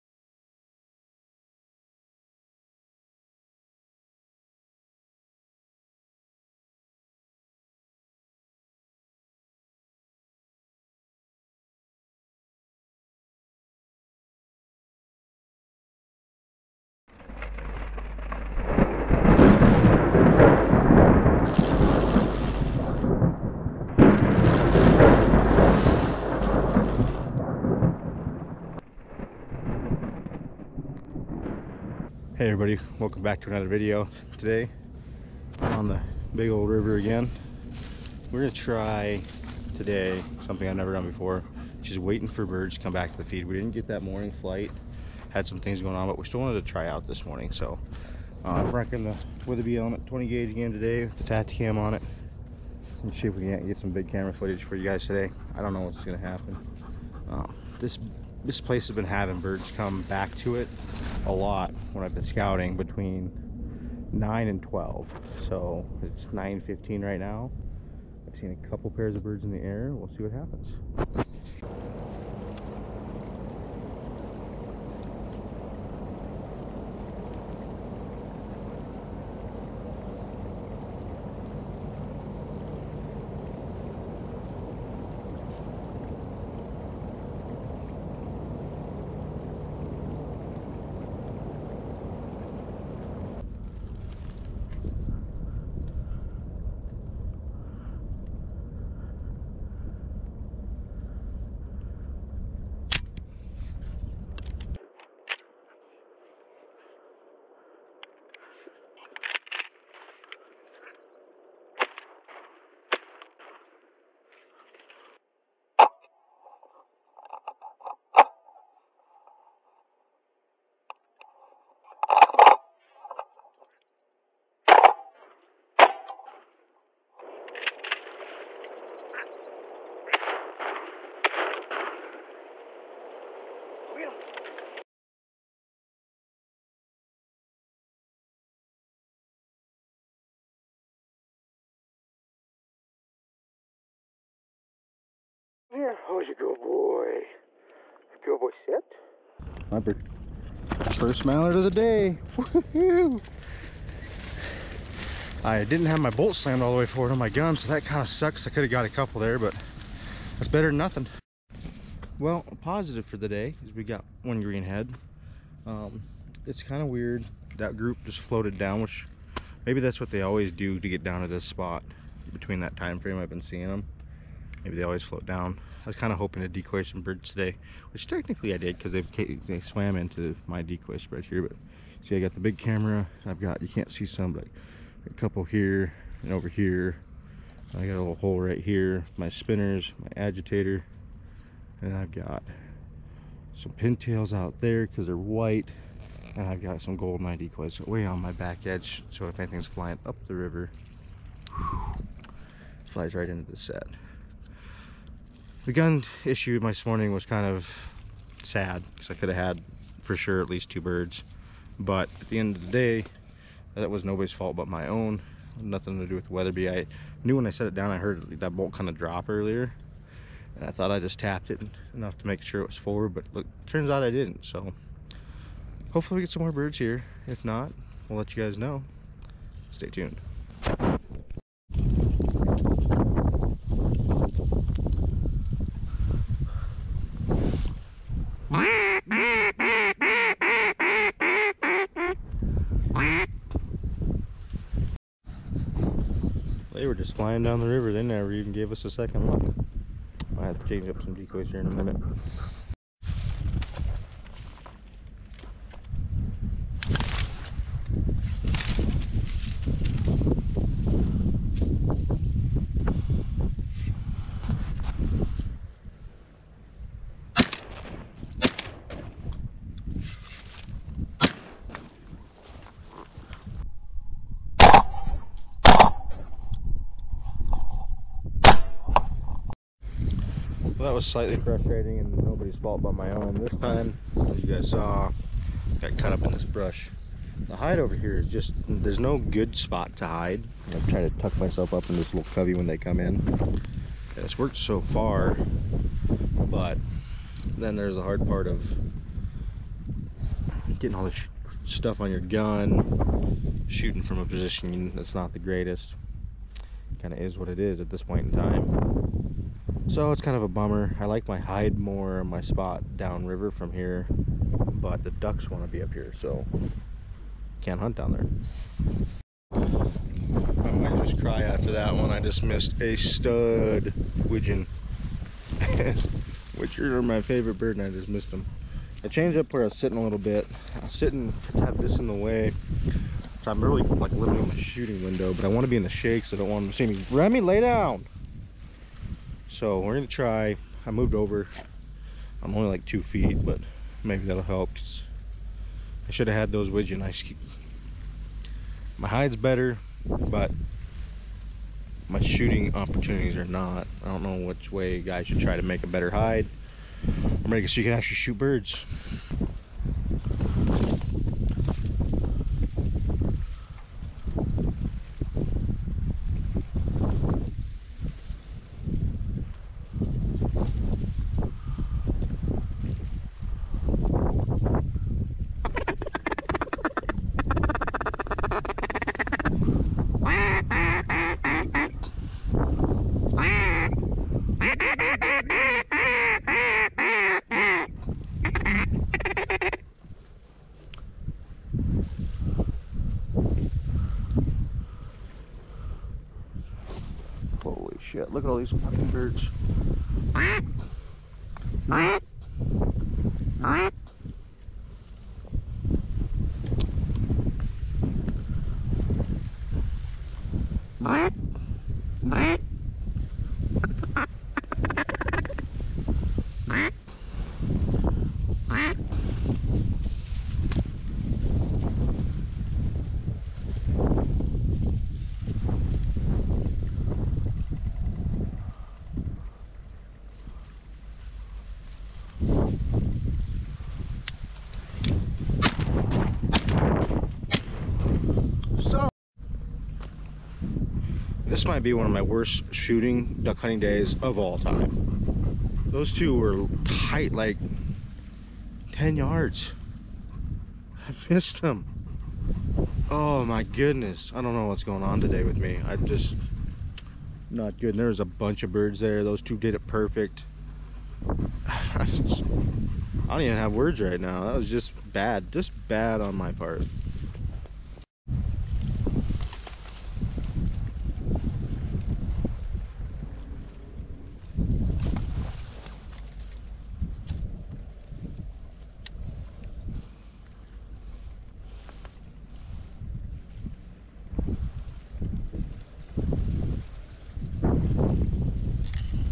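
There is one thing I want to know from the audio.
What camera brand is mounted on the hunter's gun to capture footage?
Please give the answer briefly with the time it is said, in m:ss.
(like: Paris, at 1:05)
Tactacam, at 0:51.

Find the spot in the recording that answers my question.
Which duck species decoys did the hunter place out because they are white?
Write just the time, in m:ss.
3:13.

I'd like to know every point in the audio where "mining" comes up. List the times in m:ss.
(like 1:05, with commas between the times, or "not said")
not said.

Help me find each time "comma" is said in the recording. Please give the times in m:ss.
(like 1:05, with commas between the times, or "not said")
not said.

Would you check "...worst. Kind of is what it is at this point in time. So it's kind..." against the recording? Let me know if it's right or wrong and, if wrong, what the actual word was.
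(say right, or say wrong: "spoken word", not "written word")
wrong: "greatest", not "worst".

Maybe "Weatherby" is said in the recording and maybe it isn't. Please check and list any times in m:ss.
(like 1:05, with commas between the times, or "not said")
0:49, 3:36.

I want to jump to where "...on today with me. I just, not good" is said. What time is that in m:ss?
7:35.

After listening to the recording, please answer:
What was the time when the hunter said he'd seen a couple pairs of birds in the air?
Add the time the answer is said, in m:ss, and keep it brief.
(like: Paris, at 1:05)
9:15, at 1:06.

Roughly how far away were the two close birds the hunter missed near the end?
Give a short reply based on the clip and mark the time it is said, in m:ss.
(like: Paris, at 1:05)
10 yards, at 7:28.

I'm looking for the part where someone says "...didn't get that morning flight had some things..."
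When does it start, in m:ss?
0:43.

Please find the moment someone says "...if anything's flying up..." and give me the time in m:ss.
3:19.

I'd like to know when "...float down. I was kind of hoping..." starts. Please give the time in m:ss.
2:55.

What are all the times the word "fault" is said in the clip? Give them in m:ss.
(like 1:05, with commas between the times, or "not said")
3:34, 4:42.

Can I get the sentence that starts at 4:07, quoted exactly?
They never even gave us a second look.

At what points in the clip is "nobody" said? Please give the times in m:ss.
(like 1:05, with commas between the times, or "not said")
3:34, 4:42.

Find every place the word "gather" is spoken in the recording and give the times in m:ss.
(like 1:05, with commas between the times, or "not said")
not said.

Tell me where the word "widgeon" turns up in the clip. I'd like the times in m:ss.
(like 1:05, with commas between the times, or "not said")
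5:24, 5:46.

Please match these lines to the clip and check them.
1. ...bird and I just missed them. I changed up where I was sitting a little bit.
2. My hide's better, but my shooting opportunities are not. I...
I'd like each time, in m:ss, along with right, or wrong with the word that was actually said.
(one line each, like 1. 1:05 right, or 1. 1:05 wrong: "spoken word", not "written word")
1. 5:27 right
2. 5:48 right.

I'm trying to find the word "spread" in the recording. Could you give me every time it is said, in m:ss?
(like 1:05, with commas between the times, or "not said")
3:00.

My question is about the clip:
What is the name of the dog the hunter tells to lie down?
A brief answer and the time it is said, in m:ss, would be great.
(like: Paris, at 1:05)
Remy, at 5:37.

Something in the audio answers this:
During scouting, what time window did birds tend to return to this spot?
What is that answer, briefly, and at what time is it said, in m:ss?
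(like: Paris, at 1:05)
9 to 12, at 1:02.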